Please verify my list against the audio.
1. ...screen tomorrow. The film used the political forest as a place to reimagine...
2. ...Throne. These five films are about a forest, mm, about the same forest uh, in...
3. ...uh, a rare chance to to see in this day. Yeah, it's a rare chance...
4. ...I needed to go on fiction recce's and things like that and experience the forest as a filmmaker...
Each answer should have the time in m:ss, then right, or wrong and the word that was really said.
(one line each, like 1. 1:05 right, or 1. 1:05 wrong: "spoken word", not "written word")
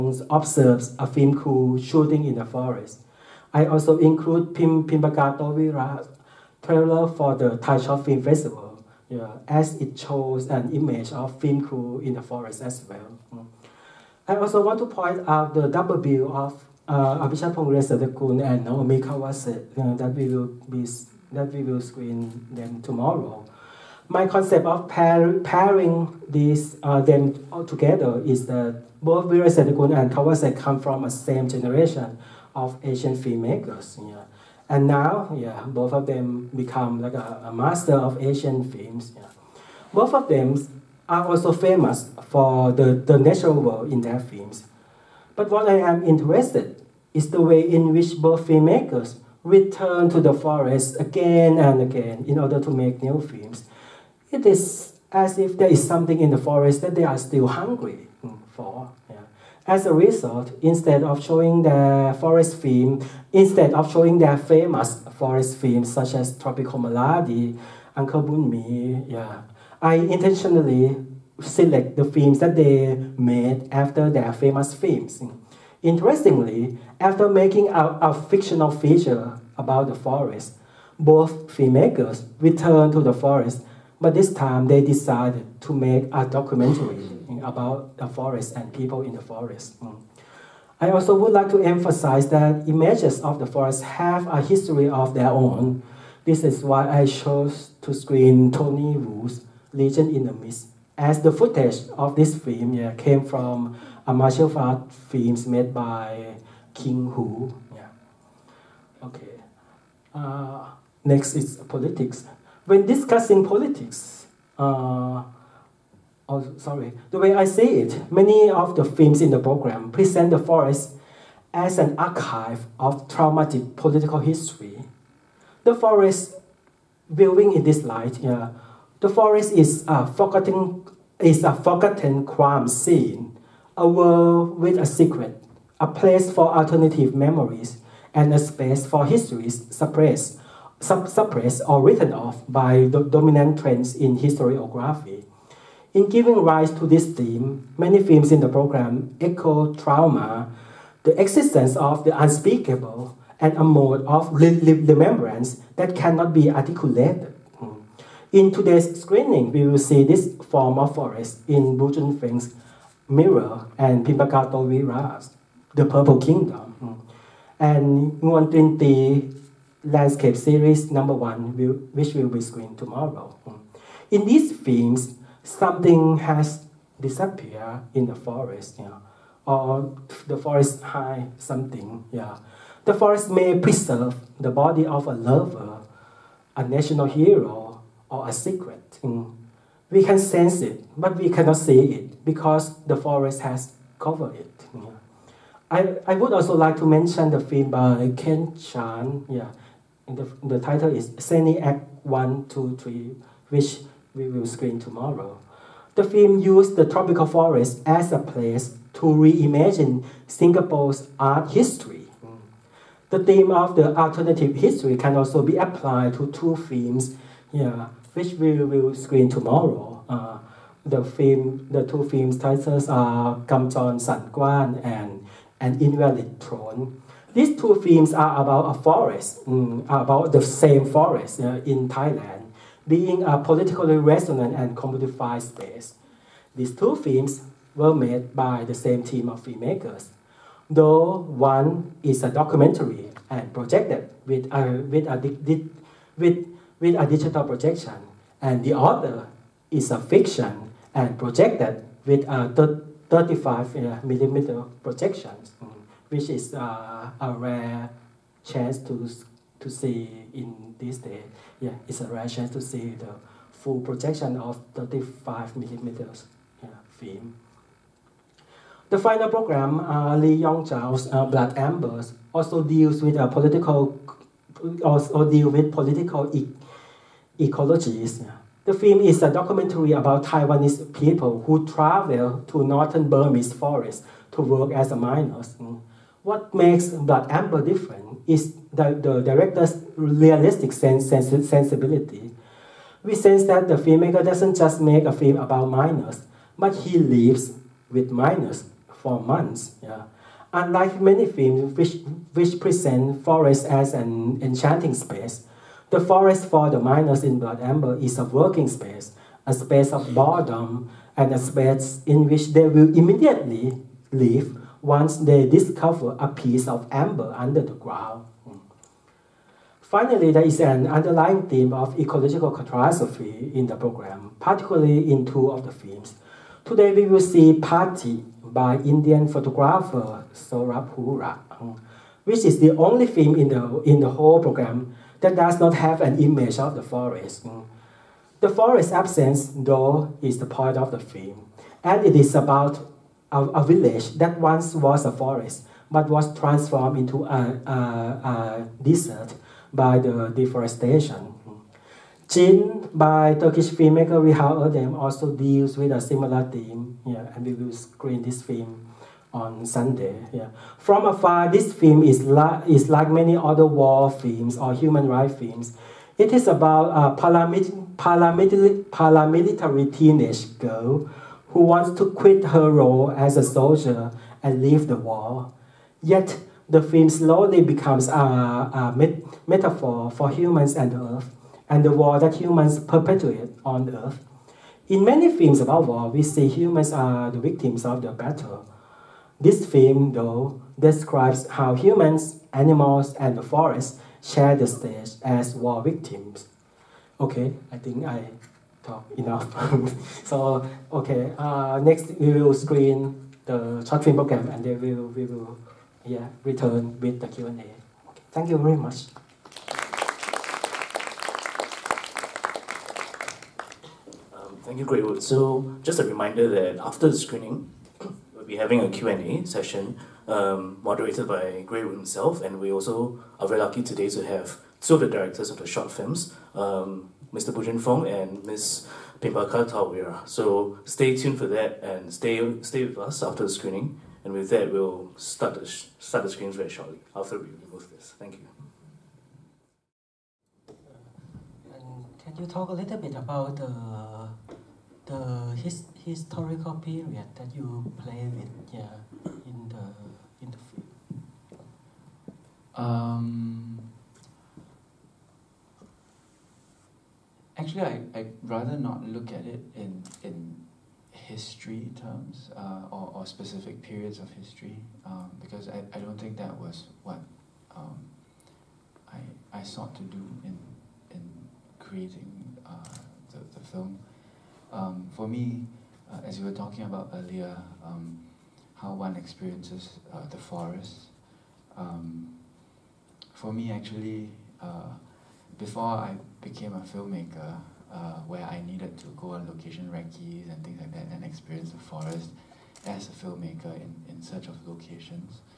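1. 3:24 wrong: "tropical", not "political"
2. 3:46 wrong: "two", not "five"
3. 4:16 right
4. 8:08 wrong: "location", not "fiction".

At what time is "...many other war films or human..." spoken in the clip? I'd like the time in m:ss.
6:03.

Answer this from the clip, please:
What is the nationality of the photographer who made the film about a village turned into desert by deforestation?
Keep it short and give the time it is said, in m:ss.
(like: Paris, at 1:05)
Indian, at 5:28.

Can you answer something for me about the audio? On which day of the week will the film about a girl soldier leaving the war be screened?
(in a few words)
Sunday.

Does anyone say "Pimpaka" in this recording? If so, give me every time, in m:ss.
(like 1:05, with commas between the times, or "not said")
0:04, 2:44, 7:09.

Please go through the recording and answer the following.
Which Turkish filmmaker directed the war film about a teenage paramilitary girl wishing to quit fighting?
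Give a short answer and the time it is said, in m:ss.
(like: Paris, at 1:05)
Reha Erdem, at 5:54.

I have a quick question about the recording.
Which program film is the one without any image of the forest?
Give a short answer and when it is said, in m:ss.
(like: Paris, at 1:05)
Party, at 5:27.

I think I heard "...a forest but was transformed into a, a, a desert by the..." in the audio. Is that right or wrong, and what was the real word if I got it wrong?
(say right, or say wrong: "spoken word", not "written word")
right.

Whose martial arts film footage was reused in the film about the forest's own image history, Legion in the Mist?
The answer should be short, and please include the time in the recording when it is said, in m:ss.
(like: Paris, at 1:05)
King Hu, at 1:46.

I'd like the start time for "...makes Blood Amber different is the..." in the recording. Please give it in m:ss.
4:46.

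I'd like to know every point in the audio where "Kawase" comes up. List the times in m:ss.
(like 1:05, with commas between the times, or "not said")
0:18, 0:30.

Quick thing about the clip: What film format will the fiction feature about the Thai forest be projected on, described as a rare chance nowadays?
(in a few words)
35 millimeter.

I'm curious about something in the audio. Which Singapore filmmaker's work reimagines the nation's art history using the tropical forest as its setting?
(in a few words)
Kent Chan.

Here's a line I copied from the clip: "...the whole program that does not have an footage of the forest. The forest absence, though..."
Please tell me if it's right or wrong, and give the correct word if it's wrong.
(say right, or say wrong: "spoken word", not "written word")
wrong: "image", not "footage".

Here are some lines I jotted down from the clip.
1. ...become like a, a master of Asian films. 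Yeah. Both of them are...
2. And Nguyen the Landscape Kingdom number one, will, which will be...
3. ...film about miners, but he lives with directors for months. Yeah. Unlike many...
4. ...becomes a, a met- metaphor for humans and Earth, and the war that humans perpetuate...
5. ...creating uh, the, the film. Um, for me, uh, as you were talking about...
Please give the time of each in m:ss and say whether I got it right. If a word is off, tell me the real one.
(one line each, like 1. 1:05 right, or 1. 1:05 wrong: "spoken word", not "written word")
1. 0:36 right
2. 2:47 wrong: "Series", not "Kingdom"
3. 4:55 wrong: "miners", not "directors"
4. 6:17 right
5. 7:51 right.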